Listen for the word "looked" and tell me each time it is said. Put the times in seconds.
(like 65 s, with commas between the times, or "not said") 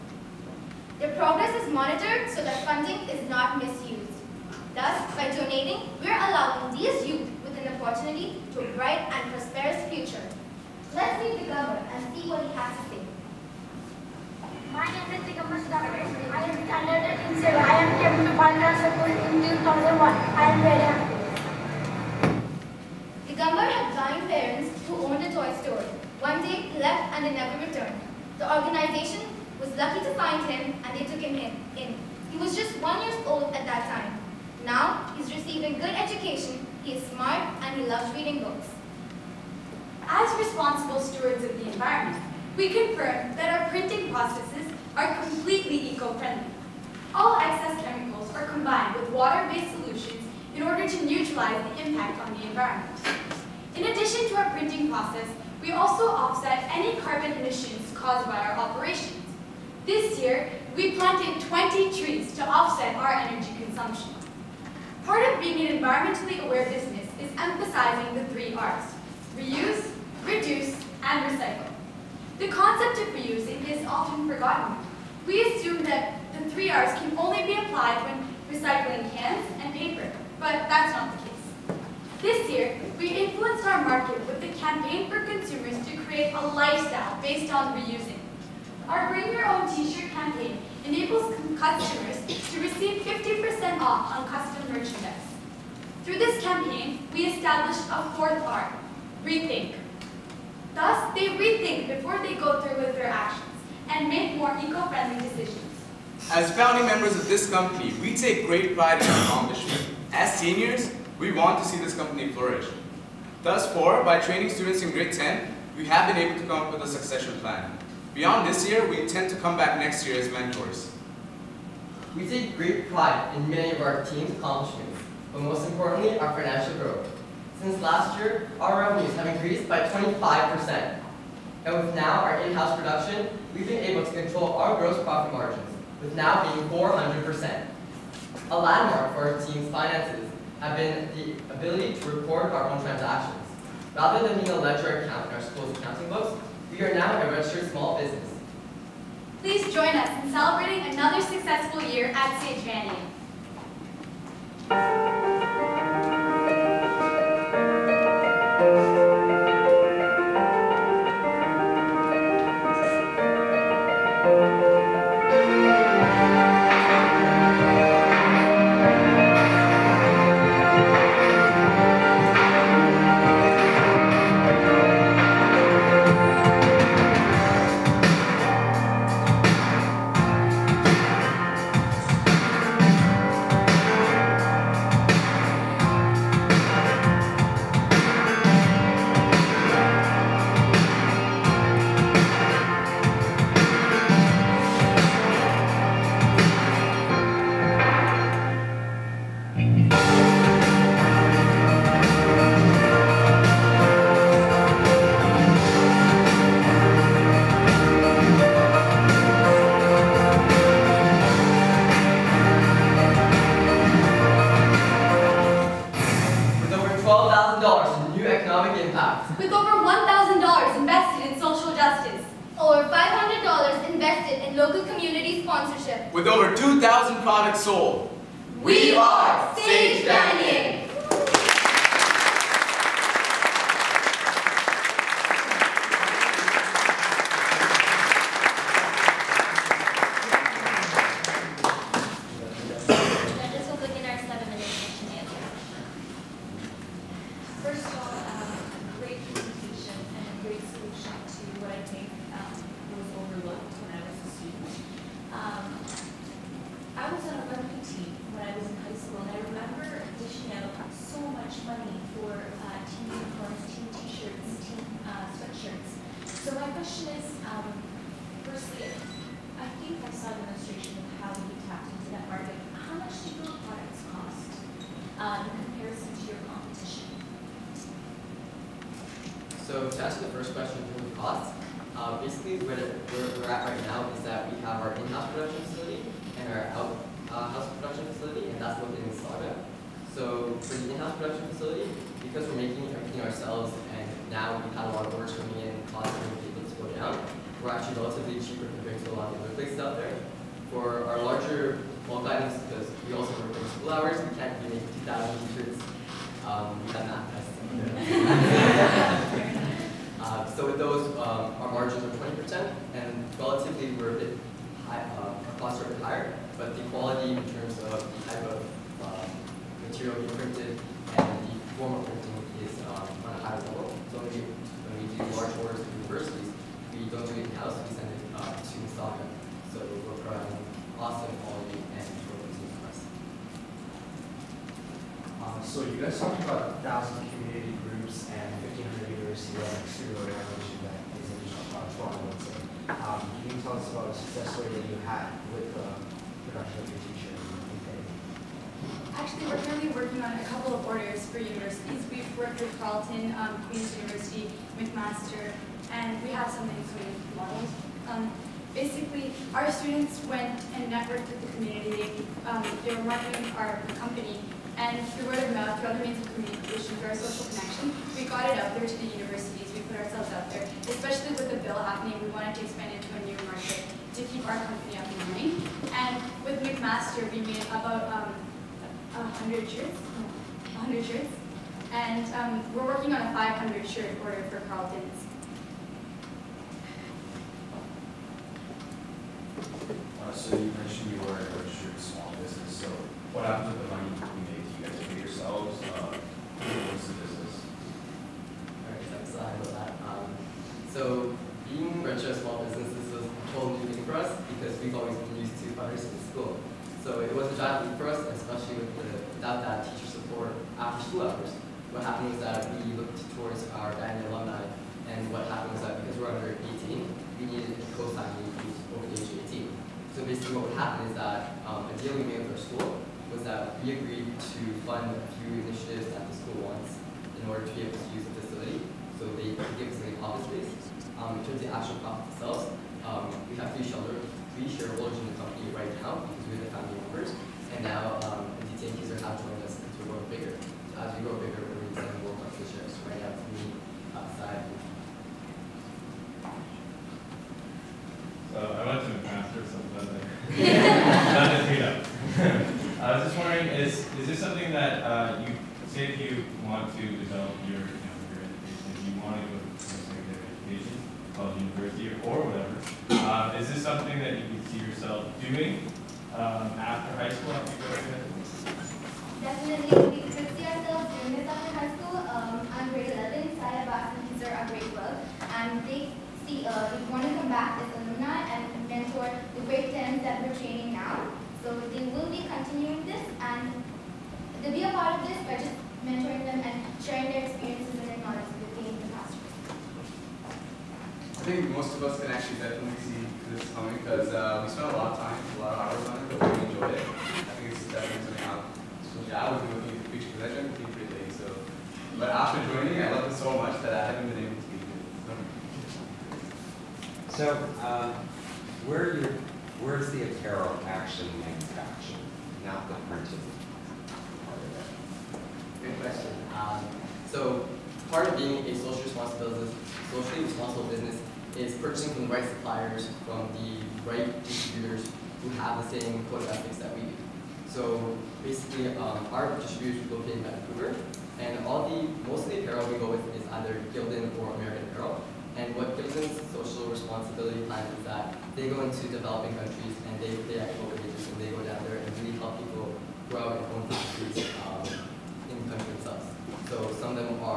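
412 s.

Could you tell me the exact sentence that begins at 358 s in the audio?
Um, basically, our students went and networked with the community.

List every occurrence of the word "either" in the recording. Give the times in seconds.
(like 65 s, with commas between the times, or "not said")
533 s.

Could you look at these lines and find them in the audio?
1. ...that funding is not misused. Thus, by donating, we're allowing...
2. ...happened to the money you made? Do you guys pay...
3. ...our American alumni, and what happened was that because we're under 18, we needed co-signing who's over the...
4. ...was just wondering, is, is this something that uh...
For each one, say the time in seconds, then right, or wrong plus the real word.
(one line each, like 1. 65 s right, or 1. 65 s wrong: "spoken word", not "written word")
1. 2 s right
2. 393 s right
3. 413 s wrong: "Diamond", not "American"
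4. 453 s right.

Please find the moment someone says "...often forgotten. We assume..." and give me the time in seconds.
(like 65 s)
73 s.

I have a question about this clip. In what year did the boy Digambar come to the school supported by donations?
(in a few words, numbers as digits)
2001.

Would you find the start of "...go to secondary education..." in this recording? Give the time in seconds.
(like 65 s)
459 s.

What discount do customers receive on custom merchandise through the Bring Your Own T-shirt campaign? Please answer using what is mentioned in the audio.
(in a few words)
50%.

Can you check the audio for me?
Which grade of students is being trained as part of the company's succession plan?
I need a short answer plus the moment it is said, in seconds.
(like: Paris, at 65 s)
Grade 10, at 114 s.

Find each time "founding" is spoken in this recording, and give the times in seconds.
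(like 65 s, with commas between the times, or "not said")
106 s.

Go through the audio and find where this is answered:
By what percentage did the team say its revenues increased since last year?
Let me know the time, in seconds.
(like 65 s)
129 s.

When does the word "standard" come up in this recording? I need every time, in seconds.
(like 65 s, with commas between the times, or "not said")
16 s.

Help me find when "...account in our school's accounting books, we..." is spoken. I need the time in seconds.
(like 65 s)
145 s.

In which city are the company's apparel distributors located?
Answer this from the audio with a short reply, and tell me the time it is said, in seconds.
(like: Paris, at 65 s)
Vancouver, at 530 s.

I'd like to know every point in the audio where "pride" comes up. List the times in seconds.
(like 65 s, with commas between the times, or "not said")
108 s, 122 s.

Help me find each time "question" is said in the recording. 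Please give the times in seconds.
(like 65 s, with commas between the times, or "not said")
280 s, 516 s.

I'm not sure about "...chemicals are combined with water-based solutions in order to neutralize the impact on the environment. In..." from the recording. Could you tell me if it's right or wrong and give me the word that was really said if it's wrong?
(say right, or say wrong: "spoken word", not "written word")
right.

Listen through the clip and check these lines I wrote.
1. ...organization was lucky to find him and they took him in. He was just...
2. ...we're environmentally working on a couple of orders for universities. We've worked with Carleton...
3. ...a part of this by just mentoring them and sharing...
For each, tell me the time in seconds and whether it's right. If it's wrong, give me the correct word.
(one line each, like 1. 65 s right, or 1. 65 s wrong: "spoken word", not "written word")
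1. 28 s right
2. 349 s wrong: "currently", not "environmentally"
3. 484 s right.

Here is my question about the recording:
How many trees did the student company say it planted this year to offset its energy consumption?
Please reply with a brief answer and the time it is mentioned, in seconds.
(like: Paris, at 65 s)
20, at 61 s.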